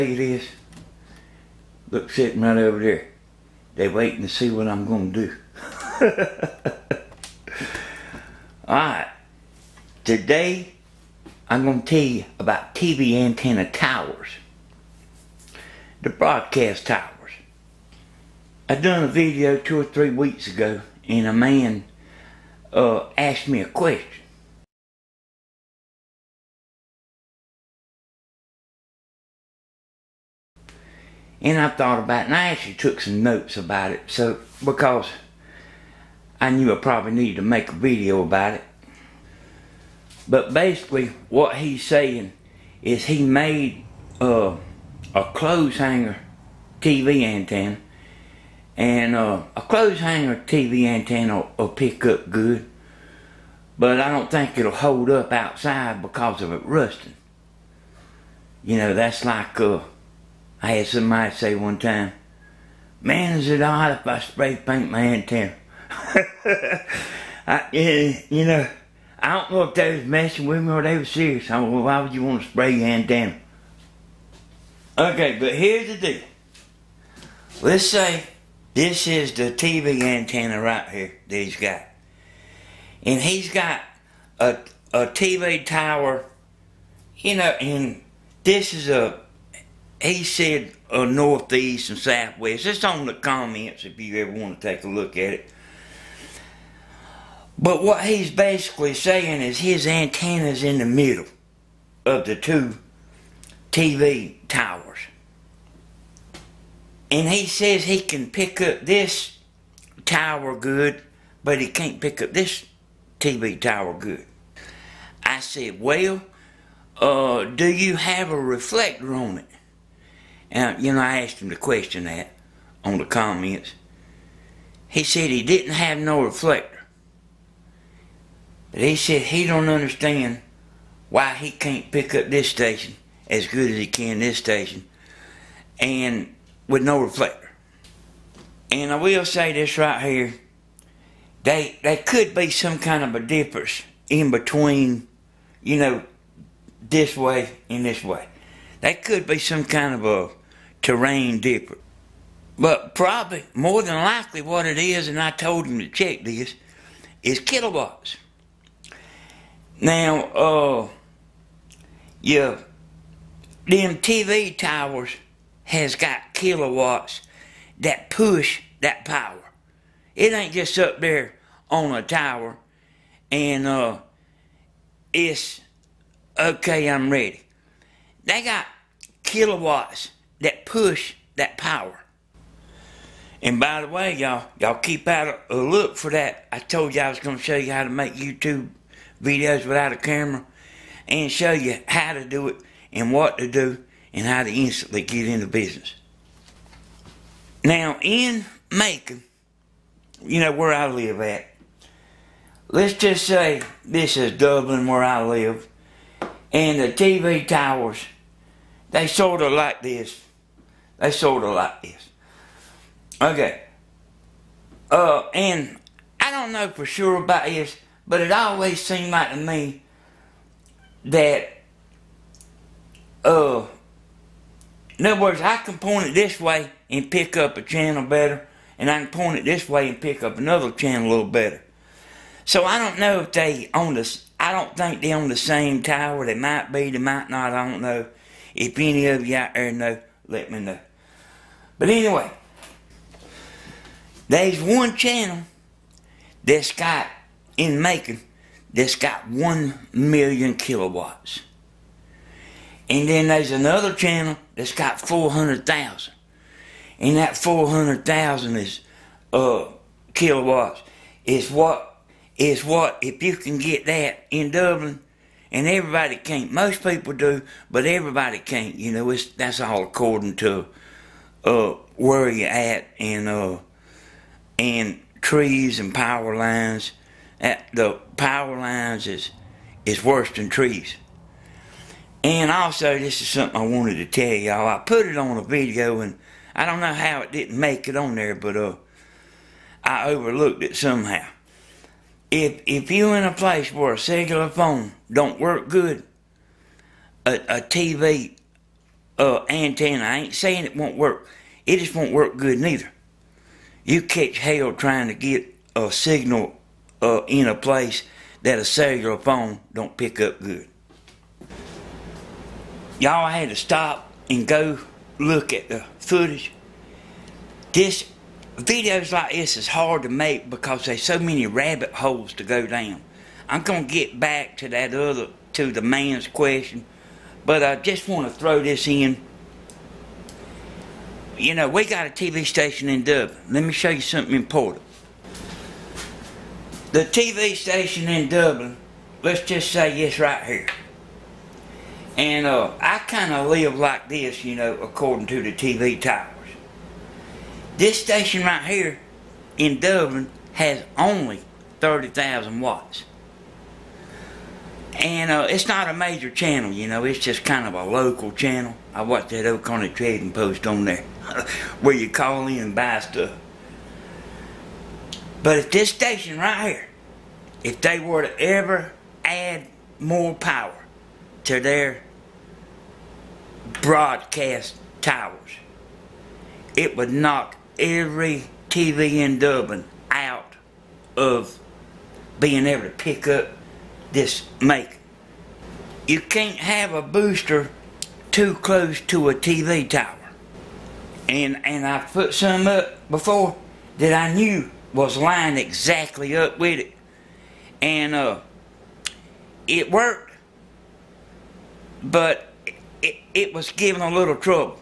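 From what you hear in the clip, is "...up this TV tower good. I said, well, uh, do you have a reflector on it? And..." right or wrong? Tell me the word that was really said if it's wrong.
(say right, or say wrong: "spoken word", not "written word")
right.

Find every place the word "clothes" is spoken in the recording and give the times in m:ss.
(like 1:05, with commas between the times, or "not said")
0:45, 0:49.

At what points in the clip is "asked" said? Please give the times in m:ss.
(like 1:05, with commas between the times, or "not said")
0:23, 2:01.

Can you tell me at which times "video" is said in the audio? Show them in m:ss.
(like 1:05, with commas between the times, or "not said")
0:19, 0:37, 3:09, 4:45, 5:18.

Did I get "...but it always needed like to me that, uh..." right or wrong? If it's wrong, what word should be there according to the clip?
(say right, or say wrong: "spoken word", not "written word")
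wrong: "seemed", not "needed".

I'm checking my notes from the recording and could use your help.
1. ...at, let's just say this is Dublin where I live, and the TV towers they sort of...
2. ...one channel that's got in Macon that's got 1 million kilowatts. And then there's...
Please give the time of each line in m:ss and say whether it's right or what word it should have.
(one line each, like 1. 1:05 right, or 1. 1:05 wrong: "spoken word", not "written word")
1. 3:21 right
2. 4:04 right.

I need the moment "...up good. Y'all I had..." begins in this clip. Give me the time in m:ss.
5:10.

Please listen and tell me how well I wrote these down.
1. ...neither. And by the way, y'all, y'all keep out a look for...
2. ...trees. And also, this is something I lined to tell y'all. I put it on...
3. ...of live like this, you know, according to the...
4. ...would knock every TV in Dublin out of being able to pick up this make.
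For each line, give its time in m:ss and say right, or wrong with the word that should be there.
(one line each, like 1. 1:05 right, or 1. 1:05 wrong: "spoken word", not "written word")
1. 3:01 wrong: "power", not "neither"
2. 4:40 wrong: "wanted", not "lined"
3. 5:43 right
4. 6:16 right.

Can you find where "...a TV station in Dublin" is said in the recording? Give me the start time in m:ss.
5:32.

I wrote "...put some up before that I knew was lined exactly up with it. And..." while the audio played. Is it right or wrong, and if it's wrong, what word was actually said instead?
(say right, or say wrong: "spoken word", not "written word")
right.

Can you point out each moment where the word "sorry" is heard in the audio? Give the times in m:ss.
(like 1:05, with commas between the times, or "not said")
not said.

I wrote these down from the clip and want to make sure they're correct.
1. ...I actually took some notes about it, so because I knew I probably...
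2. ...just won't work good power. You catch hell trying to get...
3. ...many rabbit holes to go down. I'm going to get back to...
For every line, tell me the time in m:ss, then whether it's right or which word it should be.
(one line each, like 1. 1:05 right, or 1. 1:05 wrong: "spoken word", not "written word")
1. 0:32 right
2. 5:01 wrong: "neither", not "power"
3. 5:21 right.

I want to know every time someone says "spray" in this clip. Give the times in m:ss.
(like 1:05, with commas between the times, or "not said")
1:04, 1:12.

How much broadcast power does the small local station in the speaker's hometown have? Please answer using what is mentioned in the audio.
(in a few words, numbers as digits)
30,000 watts.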